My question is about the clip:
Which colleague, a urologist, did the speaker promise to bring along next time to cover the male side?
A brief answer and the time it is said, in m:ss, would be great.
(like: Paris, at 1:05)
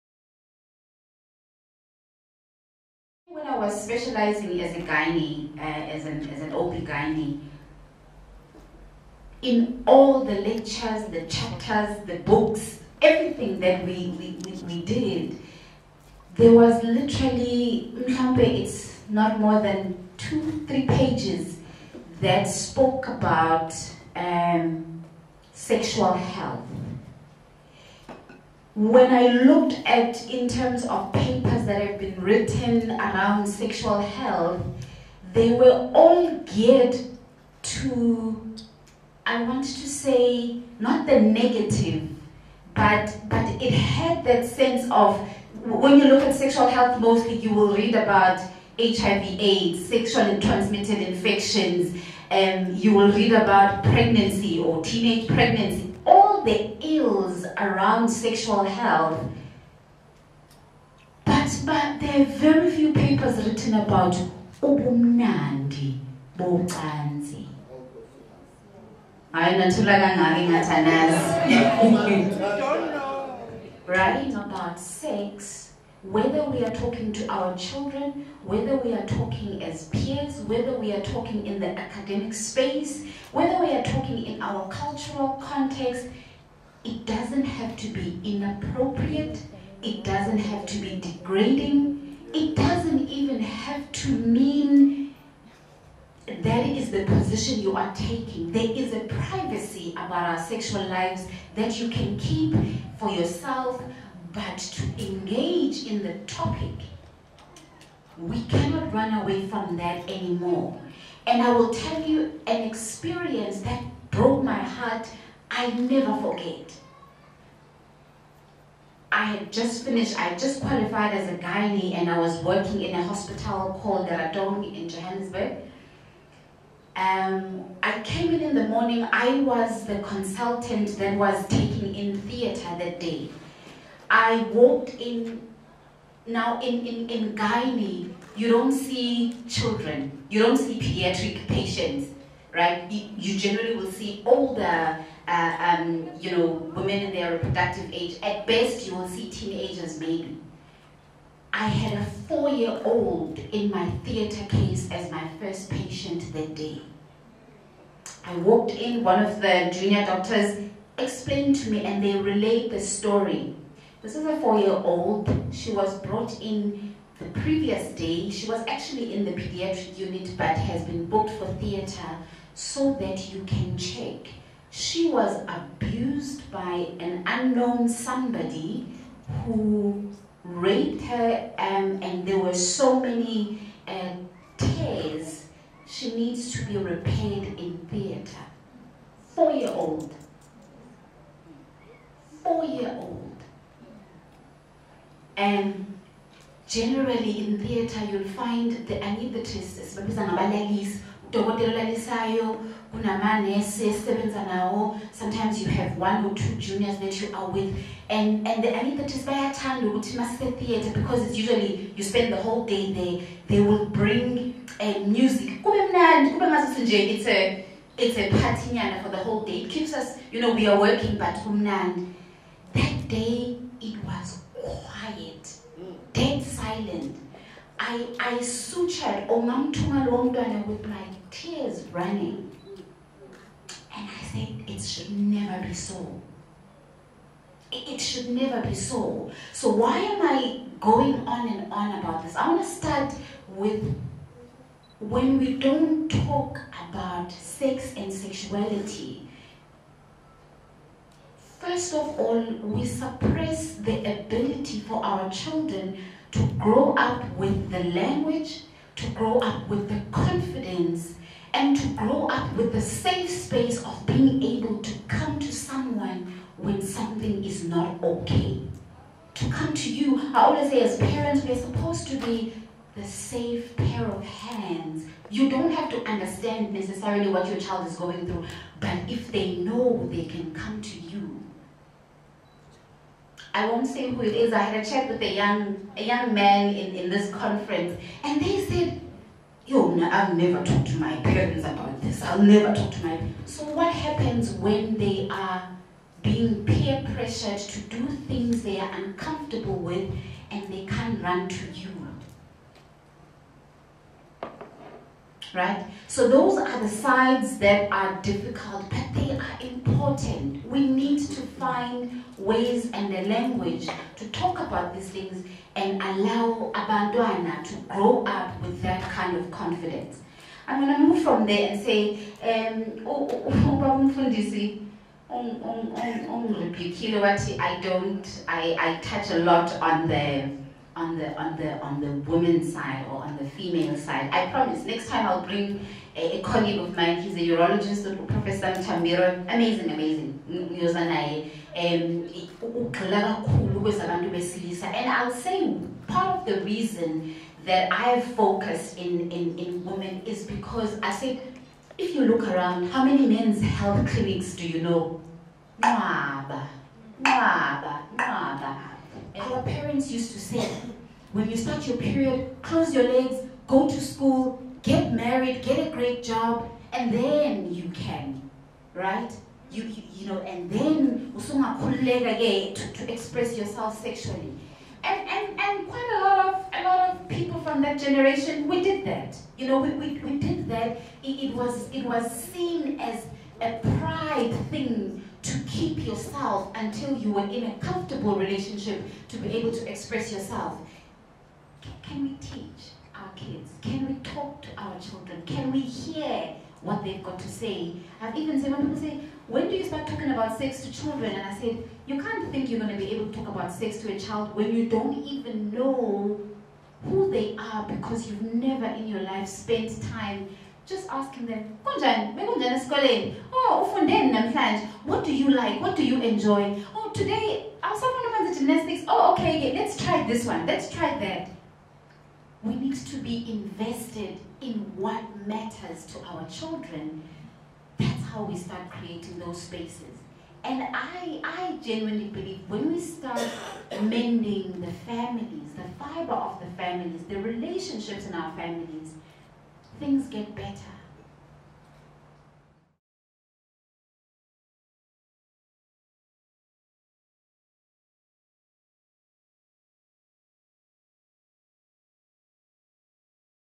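Professor Mtambiro, at 5:38.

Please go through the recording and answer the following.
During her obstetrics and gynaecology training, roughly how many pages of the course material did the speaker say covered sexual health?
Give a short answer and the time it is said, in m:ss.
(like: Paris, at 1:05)
2 or 3 pages, at 0:20.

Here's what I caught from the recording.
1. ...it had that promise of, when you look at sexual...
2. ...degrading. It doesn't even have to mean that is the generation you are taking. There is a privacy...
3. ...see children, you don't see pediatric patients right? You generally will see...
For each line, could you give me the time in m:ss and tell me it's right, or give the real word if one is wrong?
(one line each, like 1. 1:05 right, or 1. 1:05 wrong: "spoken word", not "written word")
1. 0:43 wrong: "sense", not "promise"
2. 1:30 wrong: "position", not "generation"
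3. 2:18 right.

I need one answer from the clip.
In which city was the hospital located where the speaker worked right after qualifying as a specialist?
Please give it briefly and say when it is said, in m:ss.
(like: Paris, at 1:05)
Johannesburg, at 2:04.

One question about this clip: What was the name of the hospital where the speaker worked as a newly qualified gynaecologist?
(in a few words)
Garadong.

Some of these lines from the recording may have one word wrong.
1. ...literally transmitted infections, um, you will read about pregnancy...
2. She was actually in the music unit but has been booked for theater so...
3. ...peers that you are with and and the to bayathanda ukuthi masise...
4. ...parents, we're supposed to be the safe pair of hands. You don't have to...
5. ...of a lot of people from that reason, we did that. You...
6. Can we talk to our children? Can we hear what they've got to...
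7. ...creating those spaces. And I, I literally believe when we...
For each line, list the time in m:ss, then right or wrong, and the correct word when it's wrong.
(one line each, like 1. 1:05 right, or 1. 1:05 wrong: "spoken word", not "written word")
1. 0:49 wrong: "sexually", not "literally"
2. 2:48 wrong: "pediatric", not "music"
3. 3:26 wrong: "juniors", not "peers"
4. 4:30 right
5. 6:16 wrong: "generation", not "reason"
6. 6:33 right
7. 7:08 wrong: "genuinely", not "literally".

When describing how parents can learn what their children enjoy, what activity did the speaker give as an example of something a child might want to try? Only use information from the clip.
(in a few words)
Gymnastics.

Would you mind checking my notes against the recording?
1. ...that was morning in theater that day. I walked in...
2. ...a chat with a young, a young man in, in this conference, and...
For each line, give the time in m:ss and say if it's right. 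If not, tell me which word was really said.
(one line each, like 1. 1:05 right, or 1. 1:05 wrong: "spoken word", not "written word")
1. 2:10 wrong: "taking", not "morning"
2. 4:44 right.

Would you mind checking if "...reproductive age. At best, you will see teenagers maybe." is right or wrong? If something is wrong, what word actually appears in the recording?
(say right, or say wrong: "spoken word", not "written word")
right.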